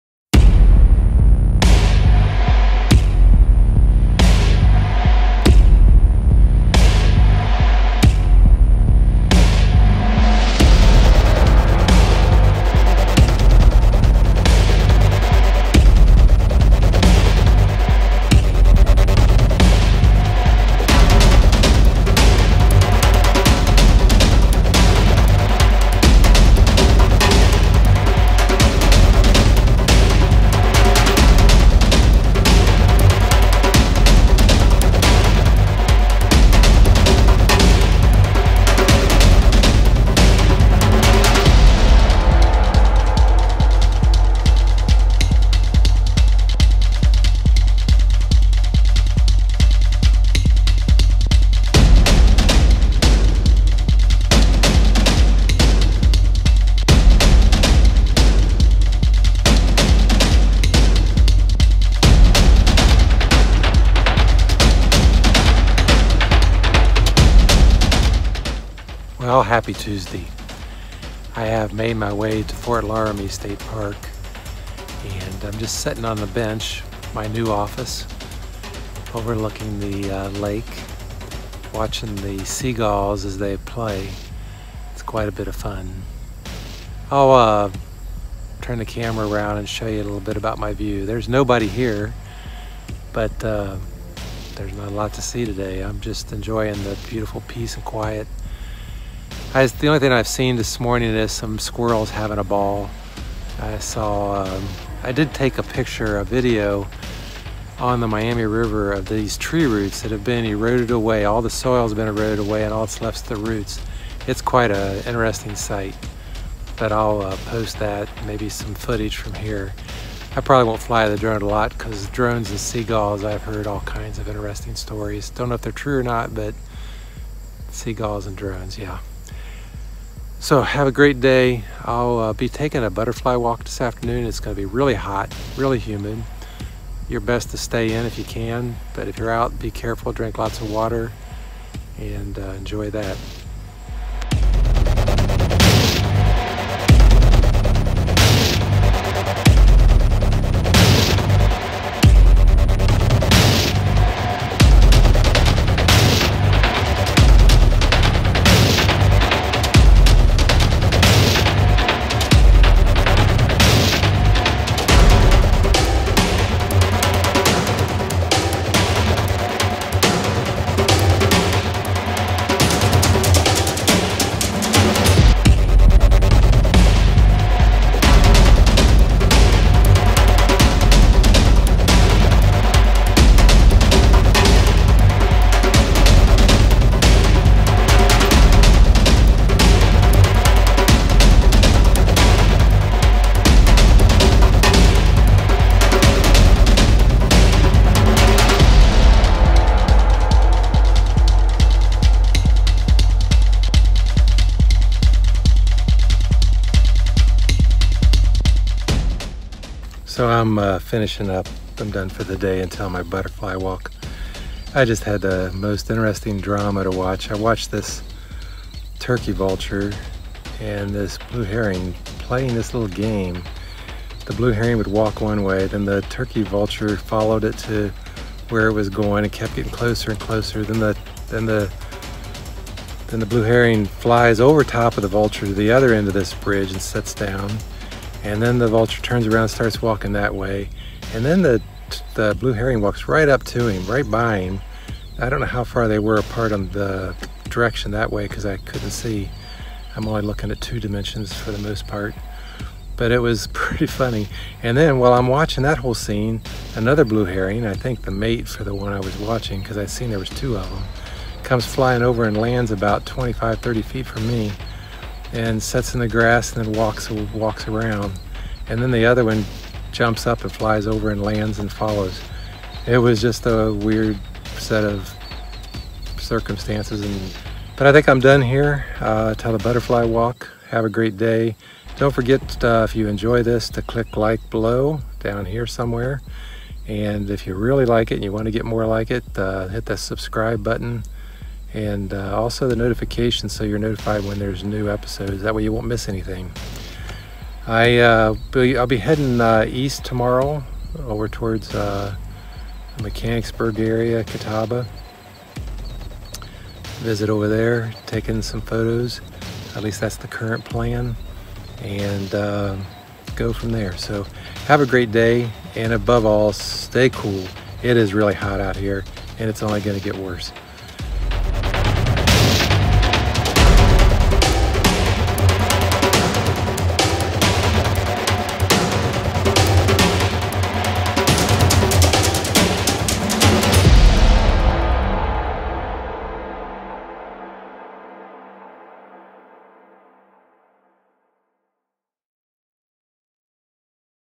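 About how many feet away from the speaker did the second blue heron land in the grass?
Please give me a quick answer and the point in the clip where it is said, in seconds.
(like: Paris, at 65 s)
25-30 feet, at 263 s.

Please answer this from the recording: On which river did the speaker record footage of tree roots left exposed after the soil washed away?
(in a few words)
Miami River.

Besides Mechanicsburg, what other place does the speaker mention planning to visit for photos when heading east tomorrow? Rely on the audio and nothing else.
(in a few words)
Catawba.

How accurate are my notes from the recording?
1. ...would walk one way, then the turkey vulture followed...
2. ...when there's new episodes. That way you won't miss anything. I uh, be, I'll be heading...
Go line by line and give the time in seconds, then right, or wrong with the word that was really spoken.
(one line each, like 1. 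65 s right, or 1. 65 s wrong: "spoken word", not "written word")
1. 224 s right
2. 294 s right.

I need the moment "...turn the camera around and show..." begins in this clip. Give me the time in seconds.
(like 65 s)
88 s.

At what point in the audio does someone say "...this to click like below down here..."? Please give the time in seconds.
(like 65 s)
283 s.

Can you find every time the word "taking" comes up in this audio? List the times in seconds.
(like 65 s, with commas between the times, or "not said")
132 s, 308 s.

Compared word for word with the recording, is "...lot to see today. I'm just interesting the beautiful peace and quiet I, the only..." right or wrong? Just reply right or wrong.
wrong.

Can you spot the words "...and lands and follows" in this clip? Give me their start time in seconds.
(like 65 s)
271 s.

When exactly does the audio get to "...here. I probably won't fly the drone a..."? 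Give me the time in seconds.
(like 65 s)
119 s.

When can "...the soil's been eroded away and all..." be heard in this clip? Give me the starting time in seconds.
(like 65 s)
111 s.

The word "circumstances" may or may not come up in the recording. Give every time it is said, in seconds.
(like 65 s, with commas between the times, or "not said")
276 s.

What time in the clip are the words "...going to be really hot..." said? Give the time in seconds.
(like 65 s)
134 s.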